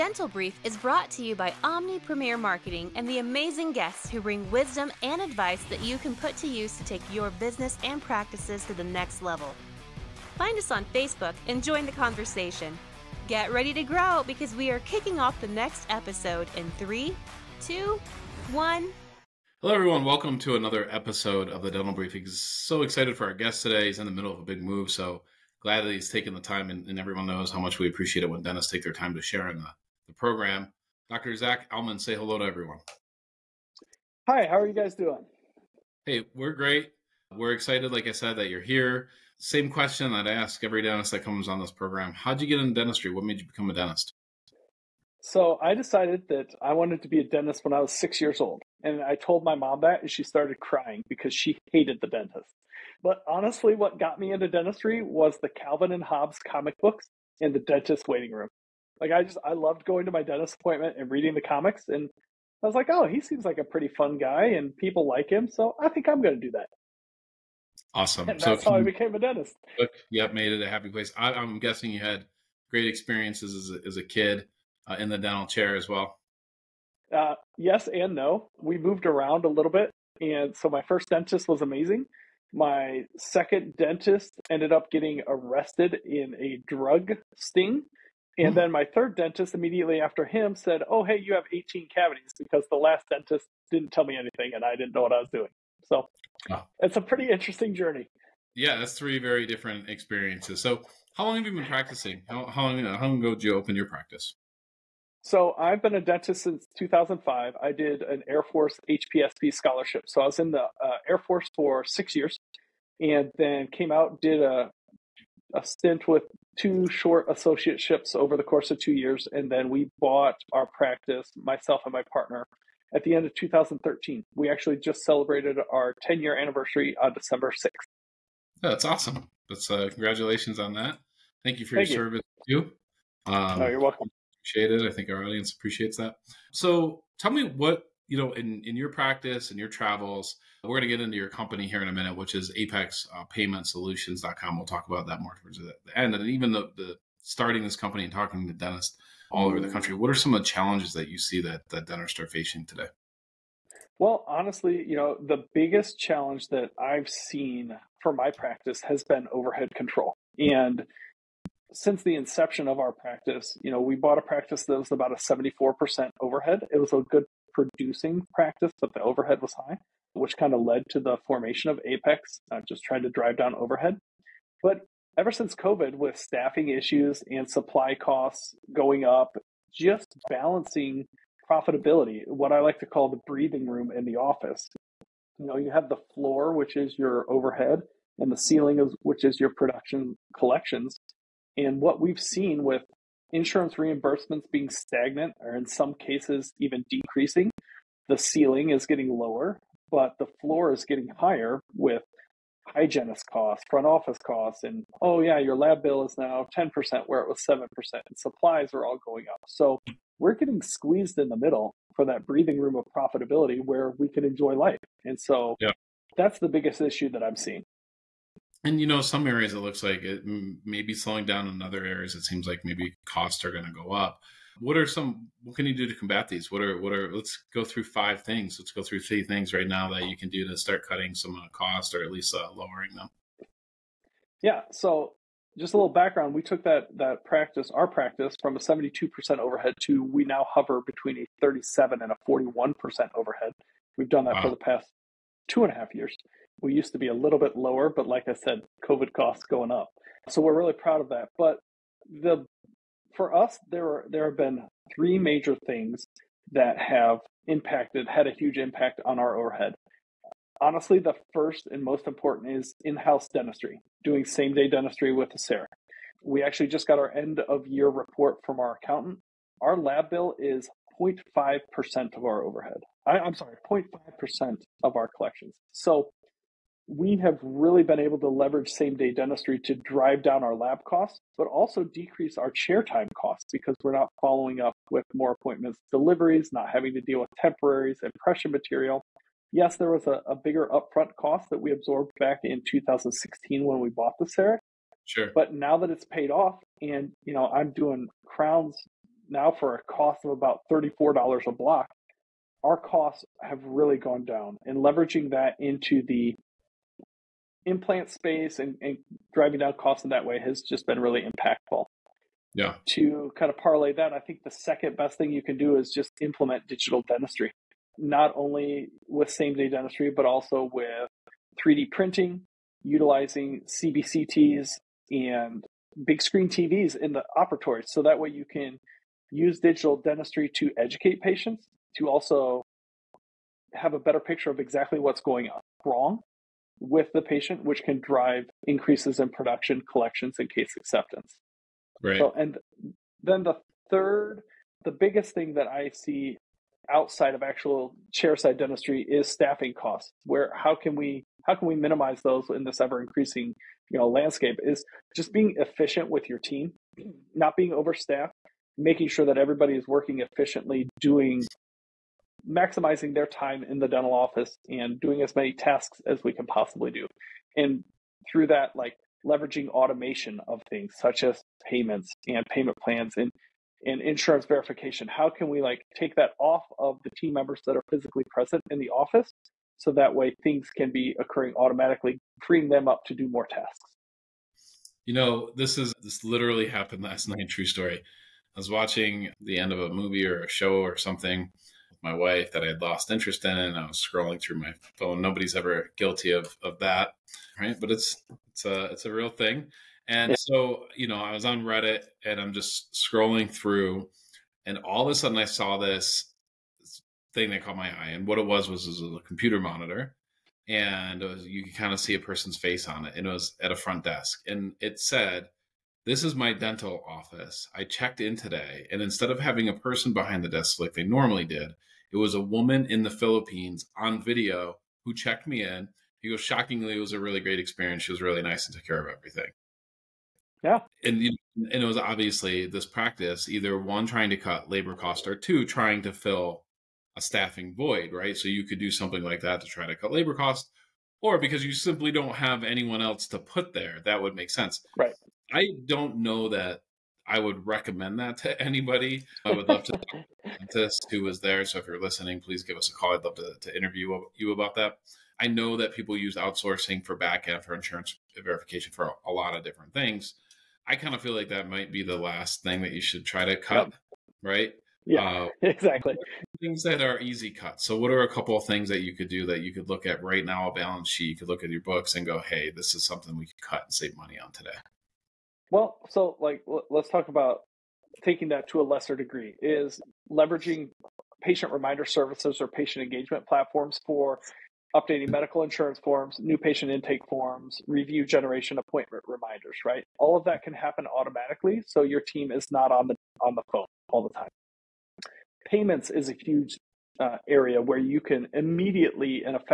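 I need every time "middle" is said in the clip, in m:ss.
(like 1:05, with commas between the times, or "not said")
0:24, 3:31.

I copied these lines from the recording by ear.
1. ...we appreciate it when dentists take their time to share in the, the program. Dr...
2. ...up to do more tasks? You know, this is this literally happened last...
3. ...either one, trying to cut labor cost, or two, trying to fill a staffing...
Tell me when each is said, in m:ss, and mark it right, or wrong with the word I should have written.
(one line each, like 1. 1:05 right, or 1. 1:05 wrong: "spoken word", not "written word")
1. 0:27 right
2. 6:22 right
3. 7:13 right.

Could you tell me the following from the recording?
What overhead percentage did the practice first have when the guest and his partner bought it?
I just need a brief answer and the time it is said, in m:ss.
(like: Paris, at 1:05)
74%, at 2:45.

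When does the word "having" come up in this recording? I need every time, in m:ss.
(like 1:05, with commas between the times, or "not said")
4:46, 6:59.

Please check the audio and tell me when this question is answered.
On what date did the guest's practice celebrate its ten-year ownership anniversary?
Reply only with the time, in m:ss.
2:07.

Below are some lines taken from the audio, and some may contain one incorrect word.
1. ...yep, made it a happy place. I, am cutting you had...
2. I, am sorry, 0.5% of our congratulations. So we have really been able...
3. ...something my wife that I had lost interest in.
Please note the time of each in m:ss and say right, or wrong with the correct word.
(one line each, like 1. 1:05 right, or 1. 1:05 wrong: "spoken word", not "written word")
1. 1:10 wrong: "guessing", not "cutting"
2. 4:33 wrong: "collections", not "congratulations"
3. 6:30 right.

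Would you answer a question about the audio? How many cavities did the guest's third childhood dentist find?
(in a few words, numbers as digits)
18.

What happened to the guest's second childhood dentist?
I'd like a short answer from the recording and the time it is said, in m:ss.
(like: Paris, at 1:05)
Arrested in a drug sting, at 1:25.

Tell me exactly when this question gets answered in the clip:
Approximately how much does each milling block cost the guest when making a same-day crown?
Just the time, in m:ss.
5:00.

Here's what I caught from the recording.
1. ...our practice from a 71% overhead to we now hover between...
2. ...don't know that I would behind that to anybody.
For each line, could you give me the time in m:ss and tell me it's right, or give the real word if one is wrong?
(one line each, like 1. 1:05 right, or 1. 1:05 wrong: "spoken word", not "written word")
1. 3:57 wrong: "72", not "71"
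2. 7:25 wrong: "recommend", not "behind".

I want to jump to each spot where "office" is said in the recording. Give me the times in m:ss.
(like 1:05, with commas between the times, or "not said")
3:04, 3:23, 6:04, 6:18, 6:57.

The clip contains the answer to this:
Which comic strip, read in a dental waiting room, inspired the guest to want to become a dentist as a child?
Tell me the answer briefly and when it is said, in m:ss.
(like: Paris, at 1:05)
Calvin and Hobbes, at 0:55.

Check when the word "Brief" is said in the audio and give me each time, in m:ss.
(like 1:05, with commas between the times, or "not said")
0:00, 0:21.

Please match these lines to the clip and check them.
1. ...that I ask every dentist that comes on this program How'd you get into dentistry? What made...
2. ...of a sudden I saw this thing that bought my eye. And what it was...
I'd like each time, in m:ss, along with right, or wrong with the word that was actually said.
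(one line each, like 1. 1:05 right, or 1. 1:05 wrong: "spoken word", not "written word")
1. 0:40 right
2. 6:45 wrong: "caught", not "bought".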